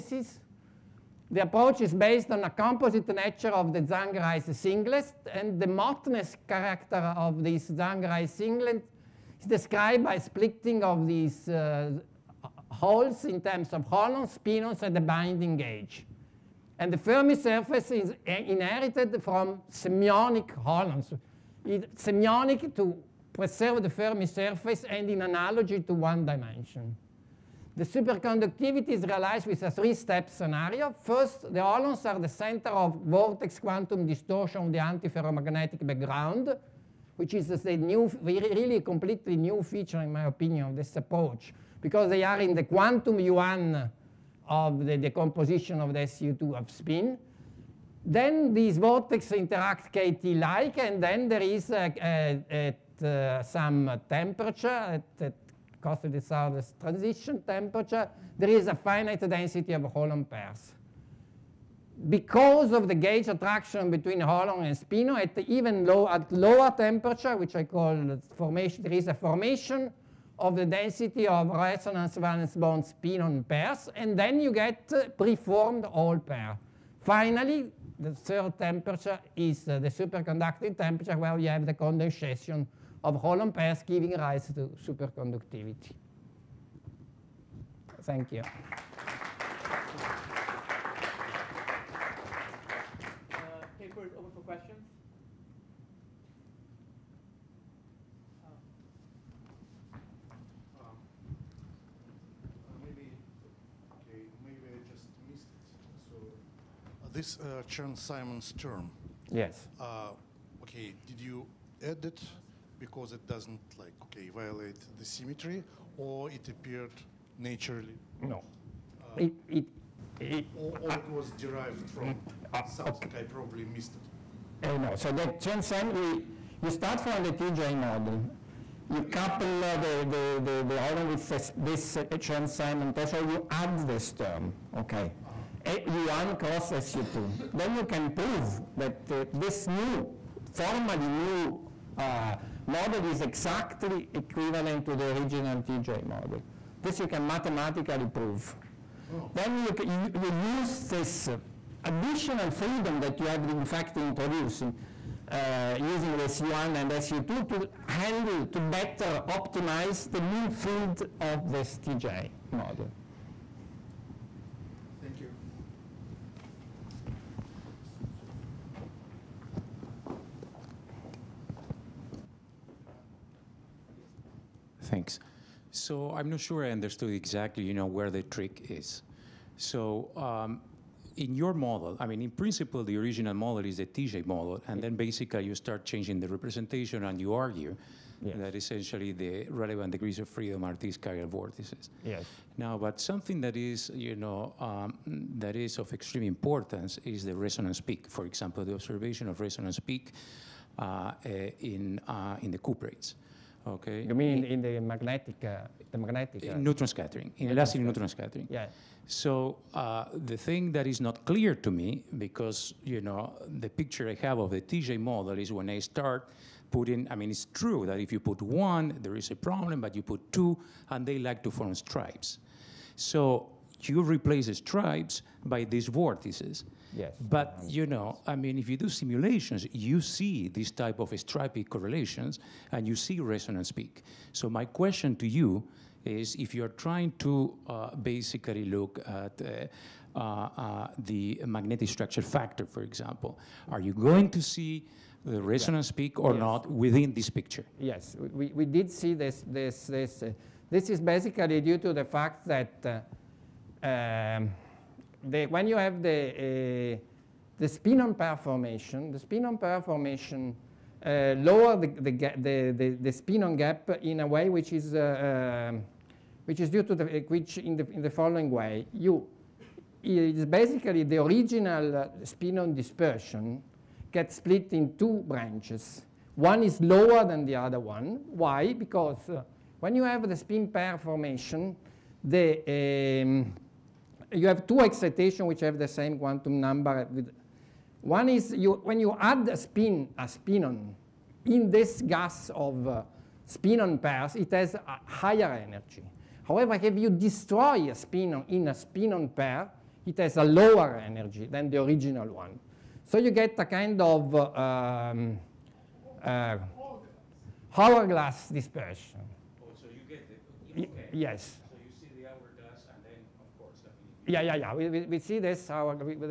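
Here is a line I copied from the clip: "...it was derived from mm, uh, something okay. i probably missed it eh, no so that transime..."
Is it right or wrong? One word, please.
right.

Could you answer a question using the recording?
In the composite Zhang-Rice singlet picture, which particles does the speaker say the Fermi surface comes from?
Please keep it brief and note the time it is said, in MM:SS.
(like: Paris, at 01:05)
Semionic holons, at 00:19.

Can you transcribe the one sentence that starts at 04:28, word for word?
You, it's basically the original uh, spinon dispersion gets split in two branches.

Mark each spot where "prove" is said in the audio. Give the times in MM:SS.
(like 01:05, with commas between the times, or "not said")
02:18, 02:28.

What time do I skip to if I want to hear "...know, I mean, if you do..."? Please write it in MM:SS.
03:47.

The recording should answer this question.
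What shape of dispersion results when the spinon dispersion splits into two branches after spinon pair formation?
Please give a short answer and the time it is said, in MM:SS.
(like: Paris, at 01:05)
Hourglass, at 05:07.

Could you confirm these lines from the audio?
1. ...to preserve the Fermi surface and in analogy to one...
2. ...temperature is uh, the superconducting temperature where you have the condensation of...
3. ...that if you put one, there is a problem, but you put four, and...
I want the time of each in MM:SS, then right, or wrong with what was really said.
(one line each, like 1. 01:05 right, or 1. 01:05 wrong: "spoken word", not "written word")
1. 00:22 right
2. 01:18 right
3. 03:37 wrong: "two", not "four".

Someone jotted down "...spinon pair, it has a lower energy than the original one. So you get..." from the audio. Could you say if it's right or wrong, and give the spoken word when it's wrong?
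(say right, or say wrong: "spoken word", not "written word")
right.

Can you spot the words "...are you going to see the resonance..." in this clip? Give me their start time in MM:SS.
04:03.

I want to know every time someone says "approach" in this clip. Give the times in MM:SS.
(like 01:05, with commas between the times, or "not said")
00:01, 00:40.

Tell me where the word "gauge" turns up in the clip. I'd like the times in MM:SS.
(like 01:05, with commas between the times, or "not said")
00:15, 01:02.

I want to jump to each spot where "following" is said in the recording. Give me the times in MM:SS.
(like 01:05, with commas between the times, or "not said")
04:28.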